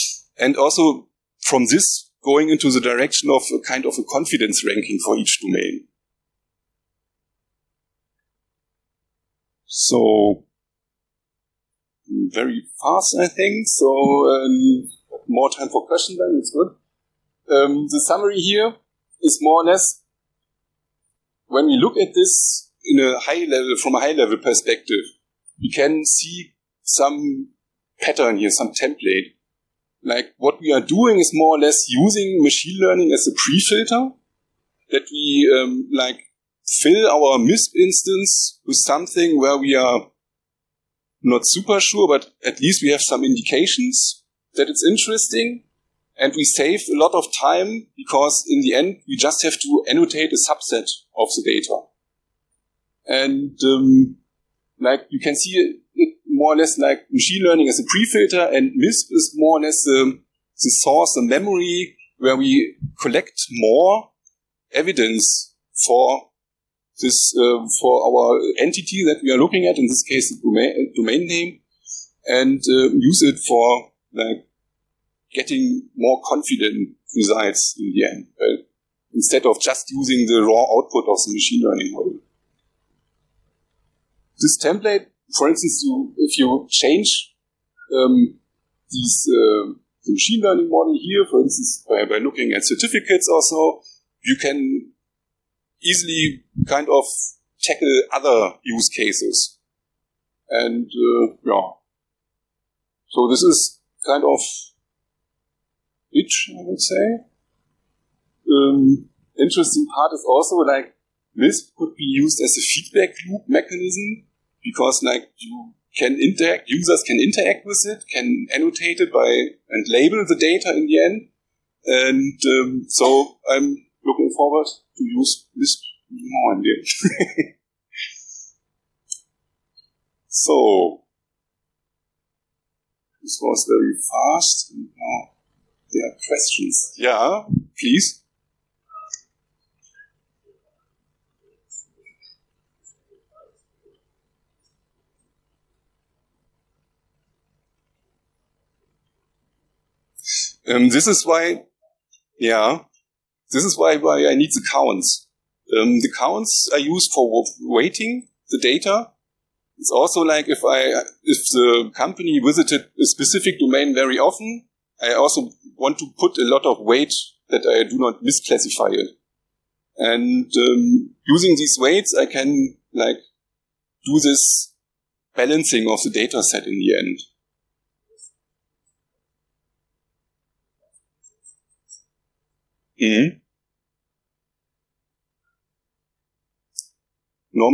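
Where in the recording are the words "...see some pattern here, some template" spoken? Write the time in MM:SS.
00:26.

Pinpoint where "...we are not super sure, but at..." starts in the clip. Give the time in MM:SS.
00:39.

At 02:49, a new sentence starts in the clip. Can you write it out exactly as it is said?
And um, using these weights, I can like do this balancing of the data set in the end.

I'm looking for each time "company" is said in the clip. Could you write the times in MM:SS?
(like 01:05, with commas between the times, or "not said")
02:41.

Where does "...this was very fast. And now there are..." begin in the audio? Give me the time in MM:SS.
02:13.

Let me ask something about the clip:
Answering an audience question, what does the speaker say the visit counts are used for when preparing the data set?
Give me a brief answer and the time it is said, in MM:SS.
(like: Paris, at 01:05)
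weighting the data, at 02:37.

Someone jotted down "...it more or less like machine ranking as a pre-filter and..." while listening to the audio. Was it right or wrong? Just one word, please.
wrong.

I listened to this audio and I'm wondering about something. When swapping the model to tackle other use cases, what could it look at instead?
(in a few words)
certificates.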